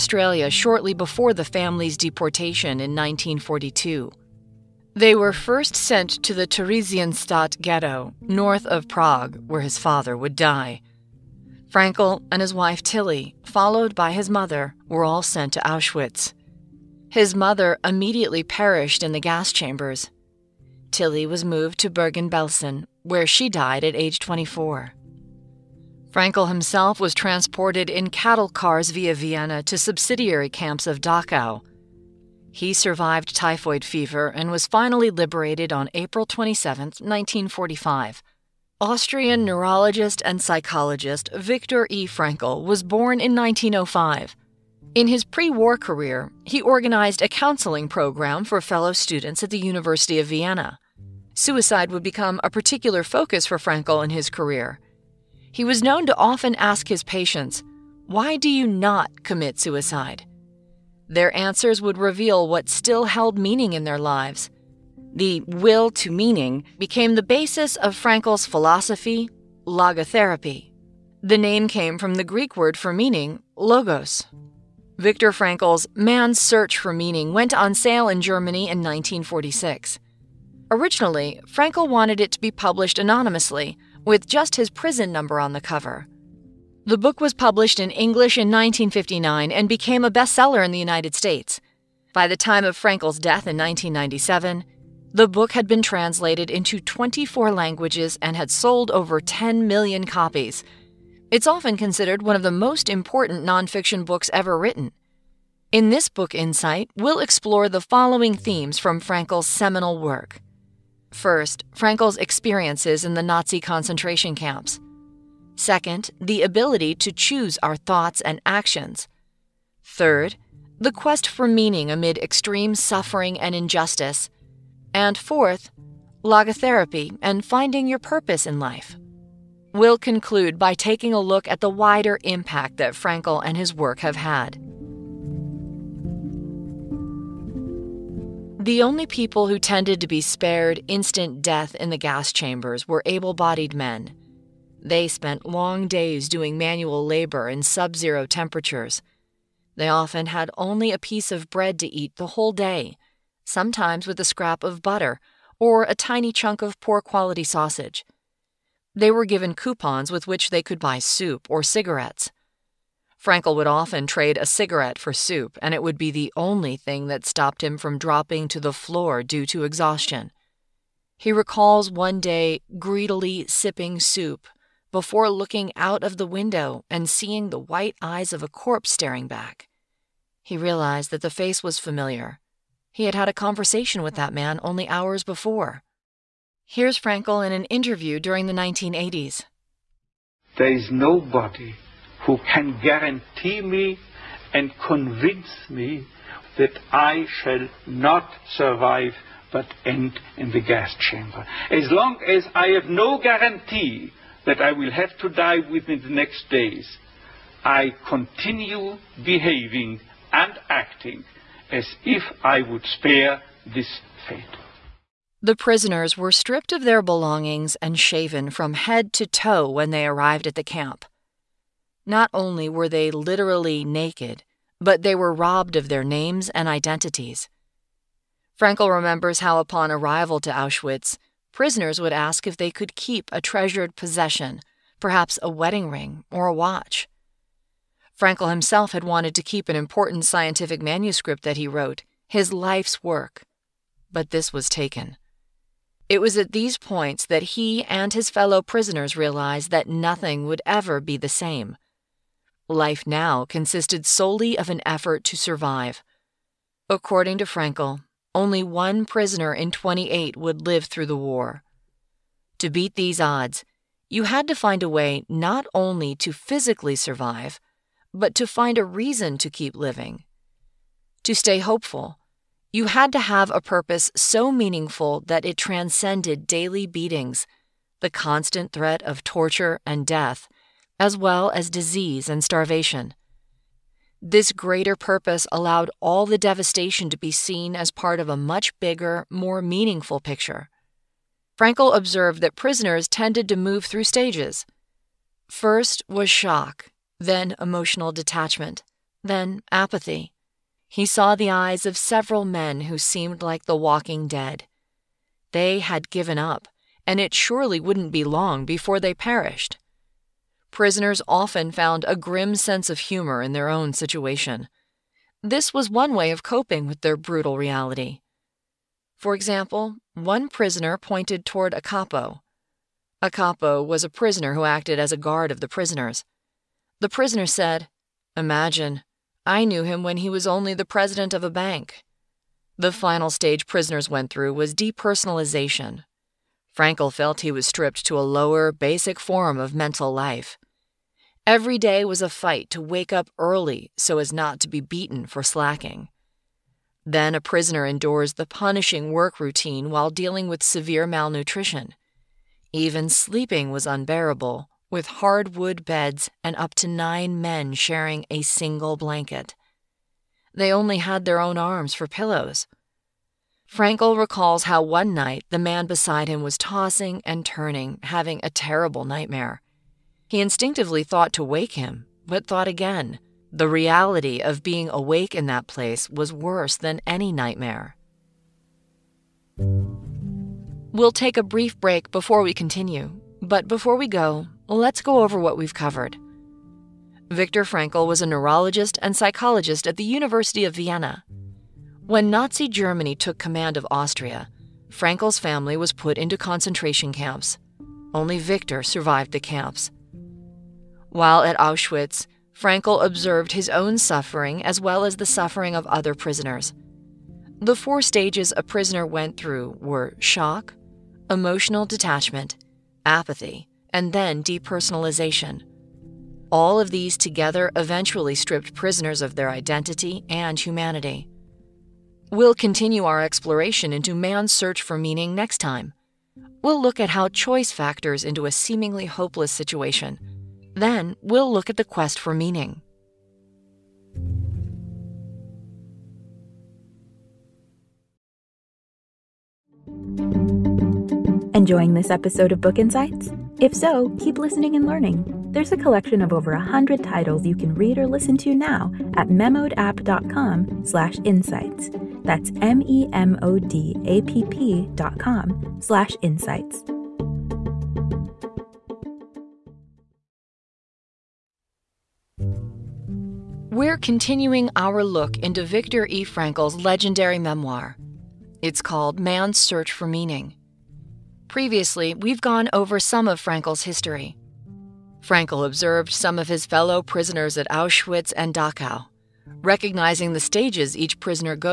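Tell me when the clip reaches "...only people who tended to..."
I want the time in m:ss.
2:18.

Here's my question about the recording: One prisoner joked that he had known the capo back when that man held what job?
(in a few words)
President of a bank.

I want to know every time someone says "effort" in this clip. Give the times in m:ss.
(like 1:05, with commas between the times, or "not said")
4:14.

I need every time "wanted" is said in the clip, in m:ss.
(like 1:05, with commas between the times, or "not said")
1:21, 3:59.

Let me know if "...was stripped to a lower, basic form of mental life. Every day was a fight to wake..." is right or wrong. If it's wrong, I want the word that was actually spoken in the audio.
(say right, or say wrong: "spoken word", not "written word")
right.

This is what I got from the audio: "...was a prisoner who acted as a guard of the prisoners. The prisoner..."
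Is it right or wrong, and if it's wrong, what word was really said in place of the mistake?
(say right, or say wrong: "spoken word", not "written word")
right.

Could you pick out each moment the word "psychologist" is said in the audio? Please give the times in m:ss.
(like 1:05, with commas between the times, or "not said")
0:40, 6:29.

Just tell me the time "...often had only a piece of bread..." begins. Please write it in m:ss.
2:29.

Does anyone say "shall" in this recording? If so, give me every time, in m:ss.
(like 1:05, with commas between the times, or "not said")
3:17.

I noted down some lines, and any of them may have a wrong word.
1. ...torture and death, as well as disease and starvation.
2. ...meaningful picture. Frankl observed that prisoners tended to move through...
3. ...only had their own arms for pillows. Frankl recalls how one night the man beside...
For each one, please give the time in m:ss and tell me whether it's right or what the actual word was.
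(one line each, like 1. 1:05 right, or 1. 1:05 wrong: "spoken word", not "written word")
1. 4:39 right
2. 4:49 right
3. 6:00 right.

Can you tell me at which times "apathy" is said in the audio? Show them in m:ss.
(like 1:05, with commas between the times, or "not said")
4:59, 6:53.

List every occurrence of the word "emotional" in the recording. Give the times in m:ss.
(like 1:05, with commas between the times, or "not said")
4:57, 6:51.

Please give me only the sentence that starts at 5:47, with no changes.
Then a prisoner endures the punishing work routine while dealing with severe malnutrition.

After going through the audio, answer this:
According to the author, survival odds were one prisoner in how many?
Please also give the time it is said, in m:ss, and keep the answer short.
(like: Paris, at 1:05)
28, at 4:18.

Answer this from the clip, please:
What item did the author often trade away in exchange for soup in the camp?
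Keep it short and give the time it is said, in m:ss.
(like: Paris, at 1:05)
A cigarette, at 2:44.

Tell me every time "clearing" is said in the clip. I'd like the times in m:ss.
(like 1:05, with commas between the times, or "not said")
not said.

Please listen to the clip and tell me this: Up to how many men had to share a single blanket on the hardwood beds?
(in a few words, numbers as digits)
9.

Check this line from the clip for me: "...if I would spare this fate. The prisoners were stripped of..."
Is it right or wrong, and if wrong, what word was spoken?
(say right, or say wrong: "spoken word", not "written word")
right.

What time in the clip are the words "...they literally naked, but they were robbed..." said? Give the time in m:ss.
3:42.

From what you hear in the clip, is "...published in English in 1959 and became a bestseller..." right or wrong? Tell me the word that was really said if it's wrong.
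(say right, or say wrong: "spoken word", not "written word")
right.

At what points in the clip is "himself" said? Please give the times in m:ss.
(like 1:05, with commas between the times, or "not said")
0:26, 3:58.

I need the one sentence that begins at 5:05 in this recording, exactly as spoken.
They had given up, and it surely wouldn't be long before they perished.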